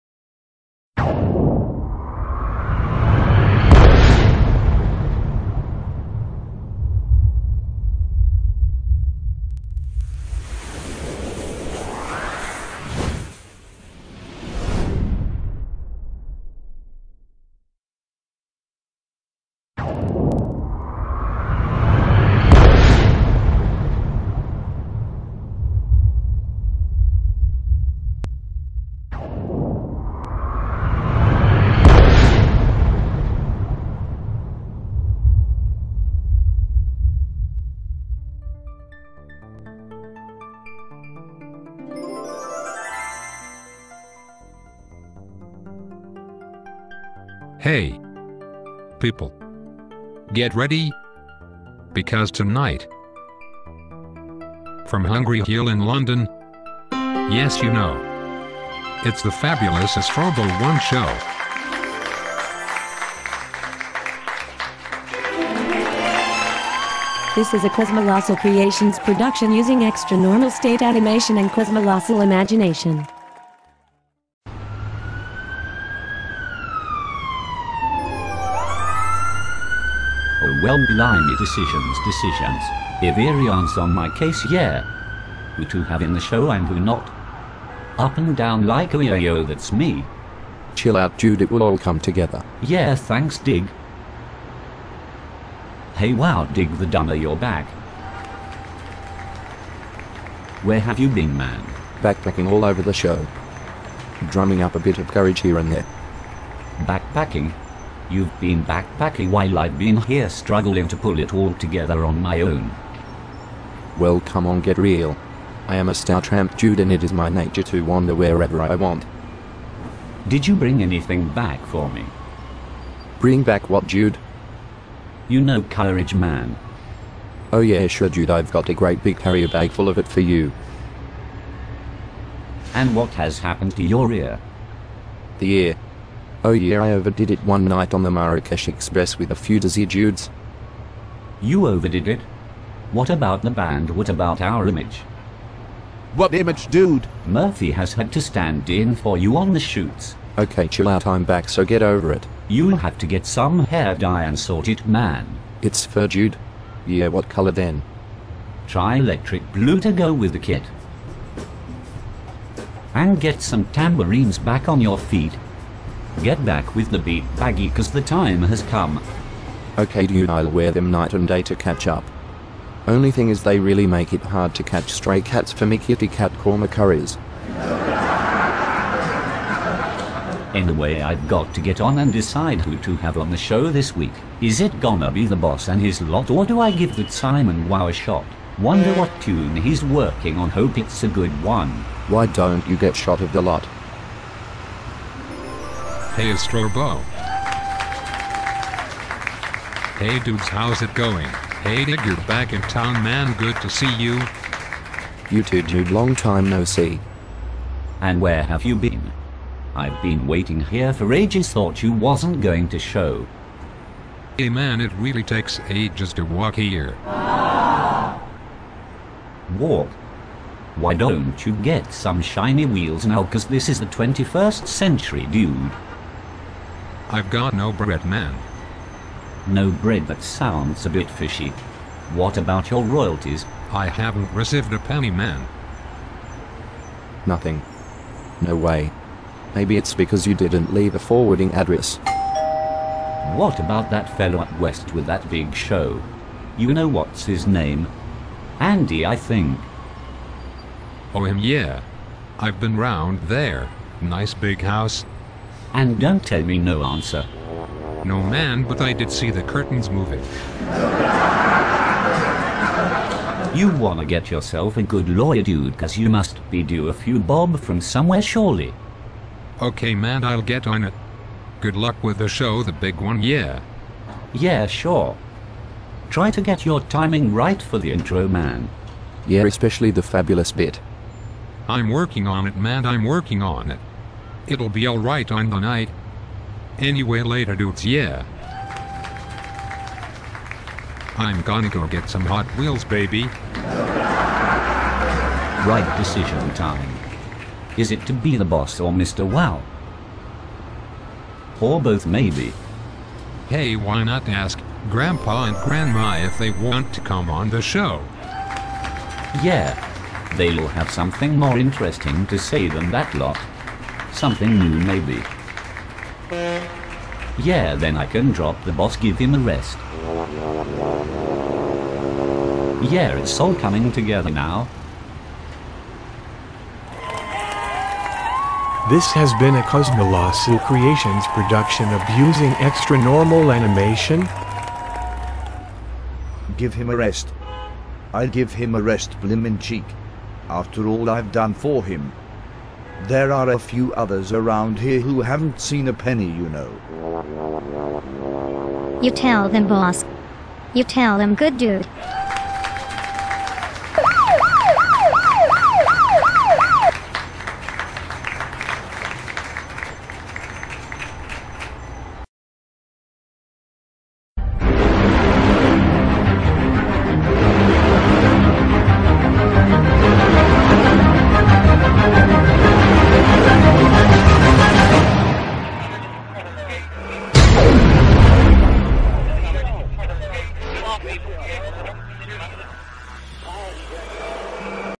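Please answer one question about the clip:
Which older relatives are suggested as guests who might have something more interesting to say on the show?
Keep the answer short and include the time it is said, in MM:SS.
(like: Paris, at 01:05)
Grandpa and Grandma, at 05:04.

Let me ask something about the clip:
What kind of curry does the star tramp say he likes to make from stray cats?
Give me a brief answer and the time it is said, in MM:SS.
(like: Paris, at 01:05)
Kitty cat korma, at 02:55.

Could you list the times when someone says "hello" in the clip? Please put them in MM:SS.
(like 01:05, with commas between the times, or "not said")
not said.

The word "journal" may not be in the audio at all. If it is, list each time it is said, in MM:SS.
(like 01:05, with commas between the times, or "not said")
not said.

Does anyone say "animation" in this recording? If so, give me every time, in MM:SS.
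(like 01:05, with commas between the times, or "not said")
01:10, 05:33.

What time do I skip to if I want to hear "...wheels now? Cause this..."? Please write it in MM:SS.
03:42.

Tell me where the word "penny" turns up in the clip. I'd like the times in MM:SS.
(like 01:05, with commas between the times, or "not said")
03:54, 05:45.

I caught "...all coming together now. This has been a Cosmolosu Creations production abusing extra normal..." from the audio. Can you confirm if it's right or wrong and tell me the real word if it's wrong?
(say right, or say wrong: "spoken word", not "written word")
right.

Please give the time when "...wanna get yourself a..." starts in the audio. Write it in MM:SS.
04:23.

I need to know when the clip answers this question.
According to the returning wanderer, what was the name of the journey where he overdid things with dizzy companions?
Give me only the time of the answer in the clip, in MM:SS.
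02:18.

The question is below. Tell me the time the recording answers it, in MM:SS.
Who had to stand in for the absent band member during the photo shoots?
02:27.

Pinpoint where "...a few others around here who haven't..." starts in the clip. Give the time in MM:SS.
05:43.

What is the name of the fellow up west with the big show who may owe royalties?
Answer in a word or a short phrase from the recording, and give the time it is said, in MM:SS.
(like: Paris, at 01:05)
Andy, at 04:08.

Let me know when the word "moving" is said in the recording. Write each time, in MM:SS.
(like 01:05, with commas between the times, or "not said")
04:19.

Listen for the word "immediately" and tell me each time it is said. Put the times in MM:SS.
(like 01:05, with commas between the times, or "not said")
not said.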